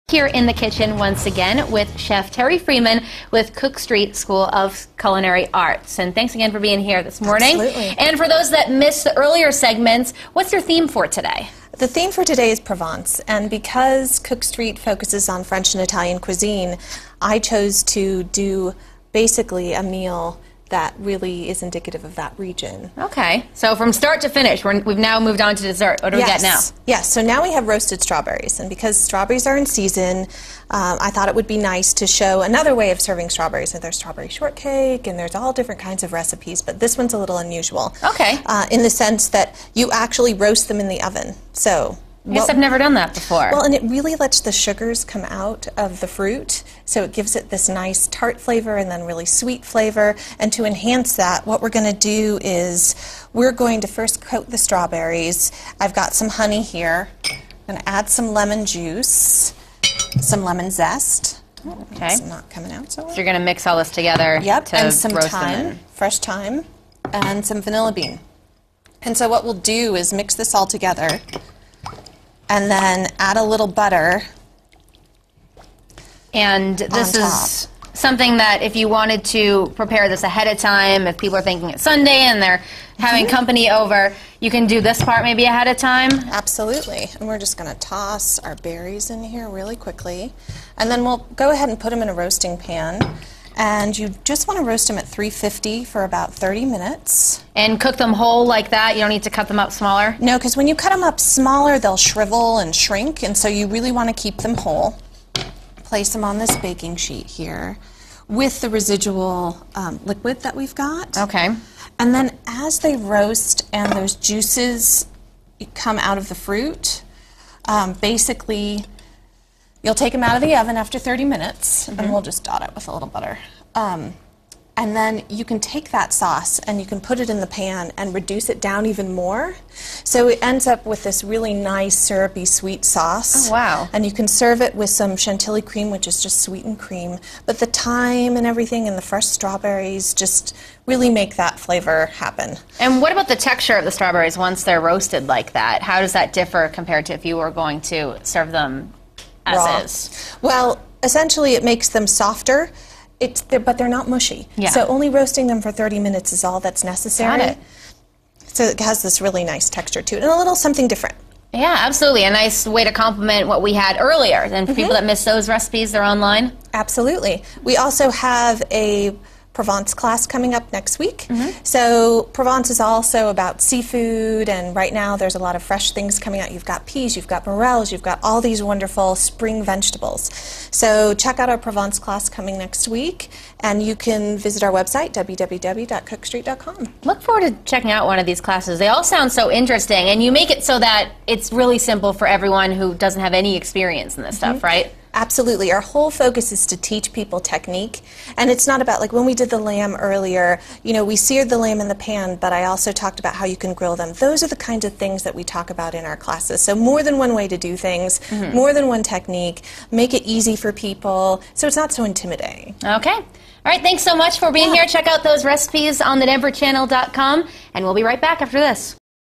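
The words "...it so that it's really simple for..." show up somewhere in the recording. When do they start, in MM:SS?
03:10.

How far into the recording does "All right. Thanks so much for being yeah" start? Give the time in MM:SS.
03:33.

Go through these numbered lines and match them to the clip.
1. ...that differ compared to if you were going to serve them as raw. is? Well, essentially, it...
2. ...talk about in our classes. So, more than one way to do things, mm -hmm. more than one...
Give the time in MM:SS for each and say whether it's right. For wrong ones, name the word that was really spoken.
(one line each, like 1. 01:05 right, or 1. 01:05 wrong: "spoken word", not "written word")
1. 02:26 right
2. 03:25 right.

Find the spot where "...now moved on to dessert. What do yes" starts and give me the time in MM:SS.
00:24.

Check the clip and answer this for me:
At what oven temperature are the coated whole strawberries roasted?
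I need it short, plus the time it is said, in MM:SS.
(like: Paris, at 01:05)
350, at 01:35.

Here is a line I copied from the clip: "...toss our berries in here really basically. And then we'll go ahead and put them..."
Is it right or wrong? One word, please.
wrong.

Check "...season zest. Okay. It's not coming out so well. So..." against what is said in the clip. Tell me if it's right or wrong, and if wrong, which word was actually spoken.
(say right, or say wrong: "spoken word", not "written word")
wrong: "lemon", not "season".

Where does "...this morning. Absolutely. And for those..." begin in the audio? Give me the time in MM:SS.
00:07.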